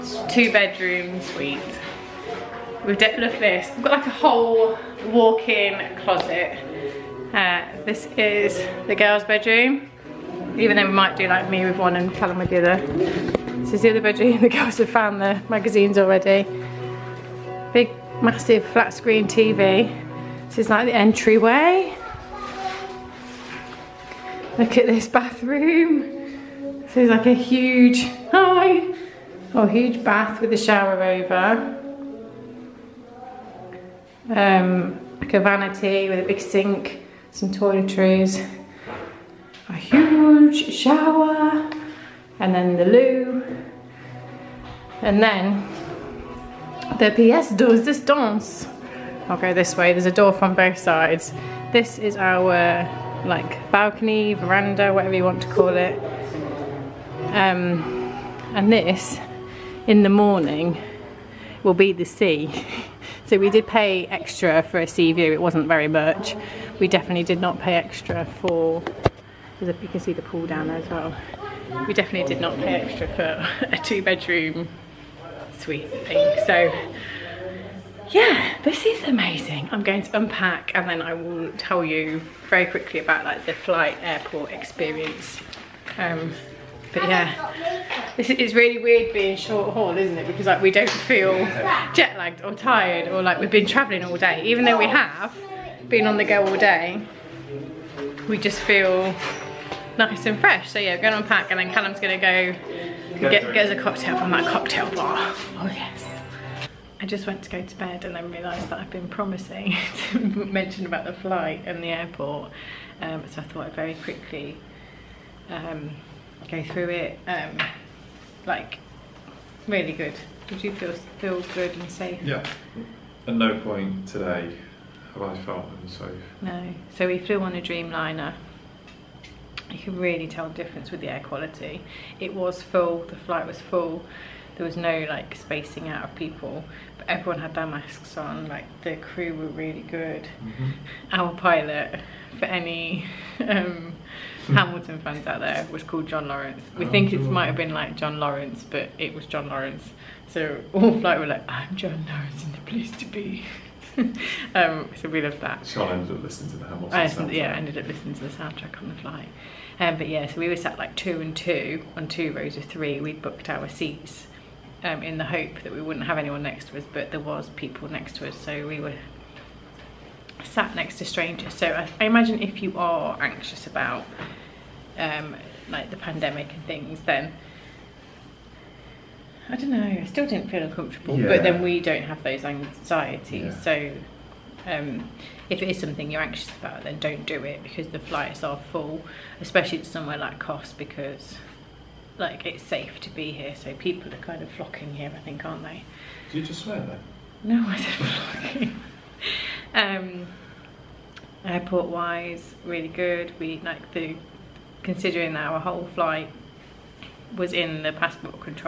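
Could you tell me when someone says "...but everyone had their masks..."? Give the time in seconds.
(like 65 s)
136 s.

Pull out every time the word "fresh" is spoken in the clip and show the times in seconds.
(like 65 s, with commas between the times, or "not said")
100 s.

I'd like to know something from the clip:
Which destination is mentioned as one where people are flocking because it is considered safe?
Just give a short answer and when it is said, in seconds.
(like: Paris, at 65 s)
Kos, at 190 s.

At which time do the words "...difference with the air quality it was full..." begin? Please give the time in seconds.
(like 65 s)
130 s.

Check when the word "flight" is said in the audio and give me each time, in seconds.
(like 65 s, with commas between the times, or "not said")
83 s, 111 s, 133 s, 150 s, 159 s, 187 s, 205 s.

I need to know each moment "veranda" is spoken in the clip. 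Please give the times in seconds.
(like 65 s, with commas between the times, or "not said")
54 s.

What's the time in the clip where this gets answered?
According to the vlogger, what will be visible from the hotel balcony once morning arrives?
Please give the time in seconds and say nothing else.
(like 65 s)
61 s.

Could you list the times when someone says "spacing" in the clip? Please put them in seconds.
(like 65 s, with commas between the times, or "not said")
135 s.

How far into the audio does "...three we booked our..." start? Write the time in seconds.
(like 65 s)
162 s.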